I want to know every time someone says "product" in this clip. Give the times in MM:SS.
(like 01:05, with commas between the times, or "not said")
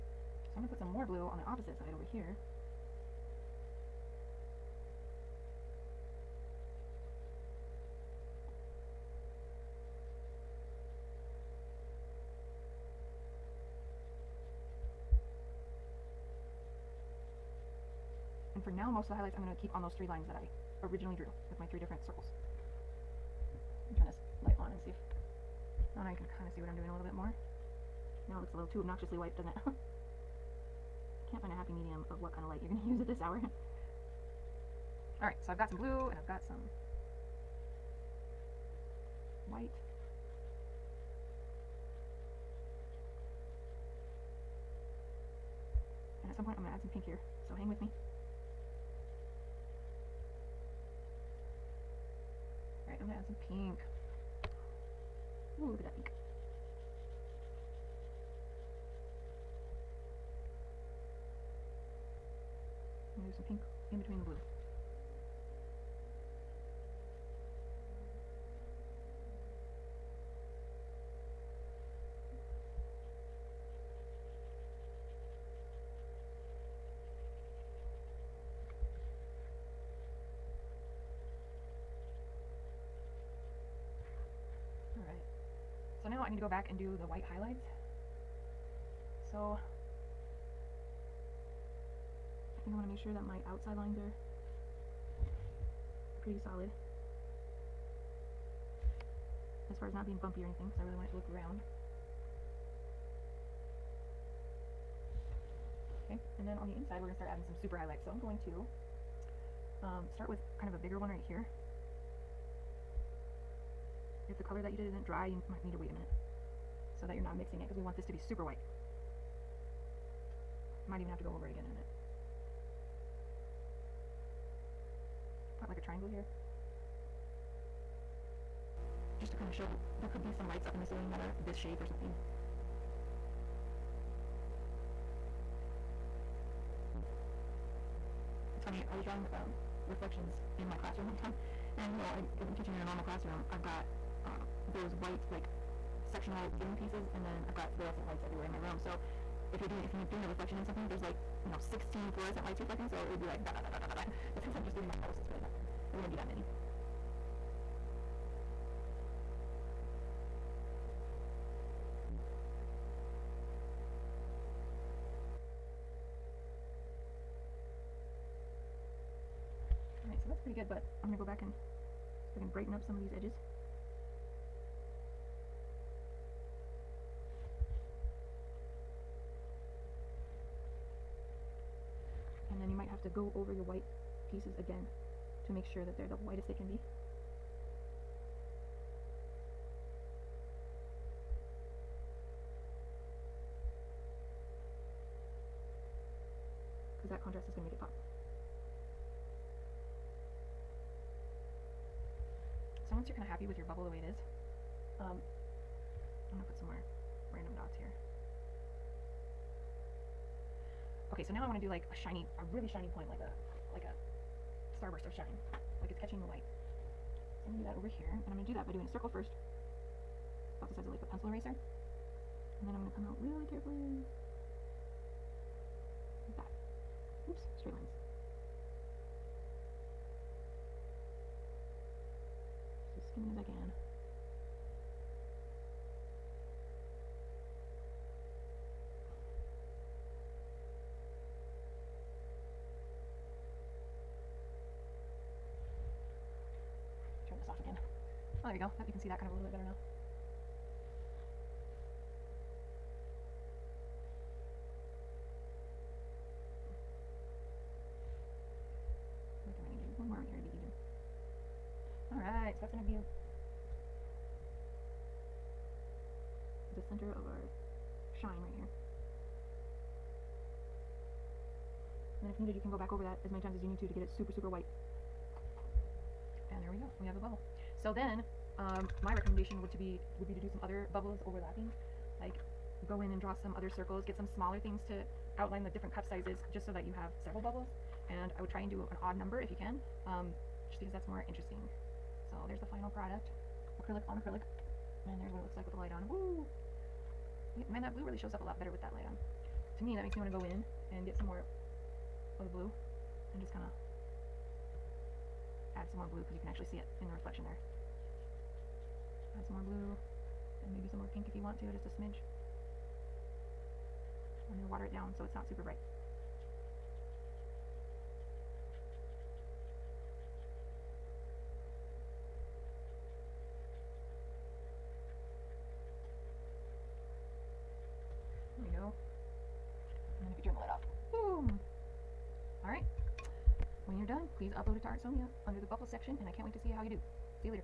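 04:52.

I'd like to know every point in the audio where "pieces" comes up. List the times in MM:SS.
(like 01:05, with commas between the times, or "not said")
02:26, 03:04.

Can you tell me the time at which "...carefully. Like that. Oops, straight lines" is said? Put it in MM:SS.
03:43.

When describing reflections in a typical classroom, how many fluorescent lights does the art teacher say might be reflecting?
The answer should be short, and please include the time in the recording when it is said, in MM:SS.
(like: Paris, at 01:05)
16, at 02:31.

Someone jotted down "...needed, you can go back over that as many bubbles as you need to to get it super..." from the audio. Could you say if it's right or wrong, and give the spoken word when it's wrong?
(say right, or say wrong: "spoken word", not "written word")
wrong: "times", not "bubbles".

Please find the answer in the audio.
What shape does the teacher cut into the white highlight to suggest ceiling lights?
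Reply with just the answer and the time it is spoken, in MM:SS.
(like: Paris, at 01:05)
Triangle, at 02:05.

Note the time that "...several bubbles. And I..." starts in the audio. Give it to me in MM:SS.
04:47.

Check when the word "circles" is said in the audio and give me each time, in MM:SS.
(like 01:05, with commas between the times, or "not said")
00:22, 03:38, 04:43.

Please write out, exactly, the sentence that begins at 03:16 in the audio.
Because that contrast is going to make it pop.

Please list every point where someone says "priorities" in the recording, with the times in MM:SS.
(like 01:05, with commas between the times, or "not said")
not said.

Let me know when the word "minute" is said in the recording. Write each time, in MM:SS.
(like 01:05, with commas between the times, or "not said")
01:55, 02:01.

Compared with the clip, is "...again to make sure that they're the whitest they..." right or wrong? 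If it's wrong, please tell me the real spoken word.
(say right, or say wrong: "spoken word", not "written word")
right.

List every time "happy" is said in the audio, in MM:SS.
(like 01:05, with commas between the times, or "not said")
00:31, 03:23.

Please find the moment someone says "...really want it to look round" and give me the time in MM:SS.
01:40.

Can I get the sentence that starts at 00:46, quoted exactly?
And at some point I'm going to add some pink here, so hang with me.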